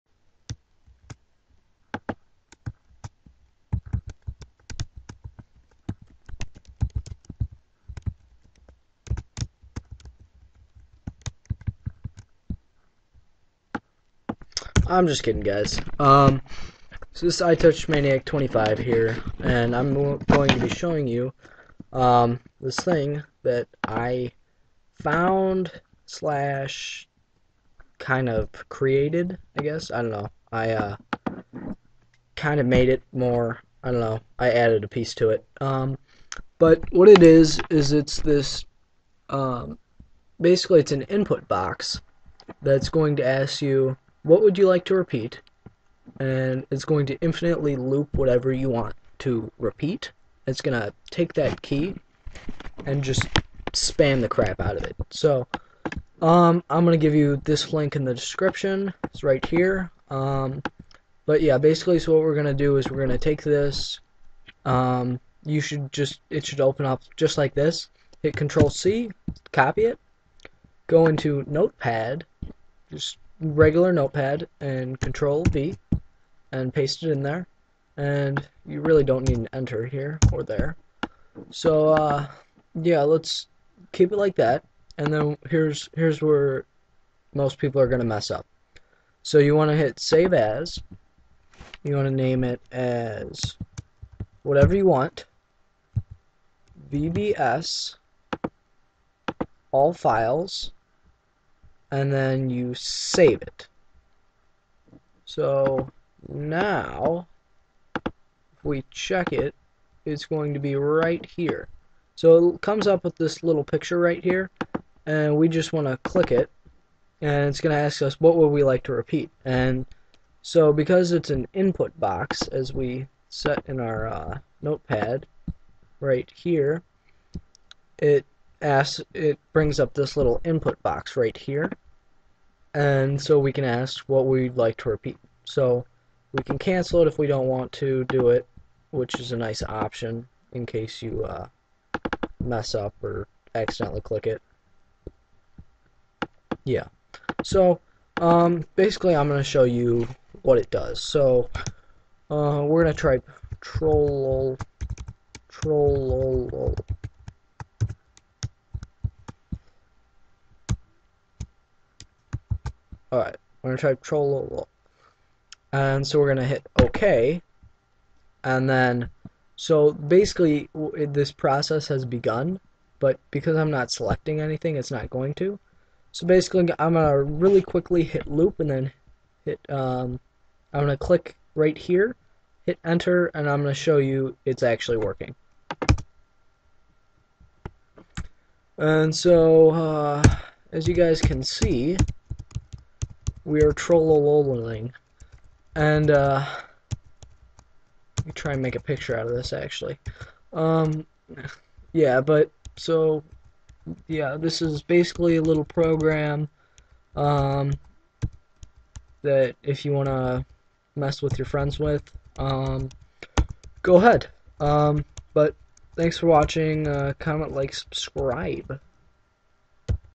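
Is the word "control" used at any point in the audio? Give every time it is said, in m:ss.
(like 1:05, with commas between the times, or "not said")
1:08, 1:14.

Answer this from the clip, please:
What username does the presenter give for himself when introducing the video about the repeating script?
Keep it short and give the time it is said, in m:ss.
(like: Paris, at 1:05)
iTouch Maniac 25, at 0:17.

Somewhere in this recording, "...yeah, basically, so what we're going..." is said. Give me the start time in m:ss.
1:01.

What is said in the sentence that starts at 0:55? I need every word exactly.
So, um, I'm going to give you this link in the description.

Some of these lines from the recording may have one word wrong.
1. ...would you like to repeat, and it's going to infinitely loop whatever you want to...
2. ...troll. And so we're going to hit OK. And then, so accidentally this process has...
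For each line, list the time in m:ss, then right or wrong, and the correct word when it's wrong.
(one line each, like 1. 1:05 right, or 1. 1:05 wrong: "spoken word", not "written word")
1. 0:44 right
2. 2:44 wrong: "basically", not "accidentally".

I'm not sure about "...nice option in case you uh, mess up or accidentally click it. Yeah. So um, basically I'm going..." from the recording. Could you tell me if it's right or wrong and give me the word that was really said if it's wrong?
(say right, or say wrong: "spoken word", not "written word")
right.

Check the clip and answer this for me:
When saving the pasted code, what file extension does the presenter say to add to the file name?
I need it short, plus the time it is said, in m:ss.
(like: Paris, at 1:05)
VBS, at 1:36.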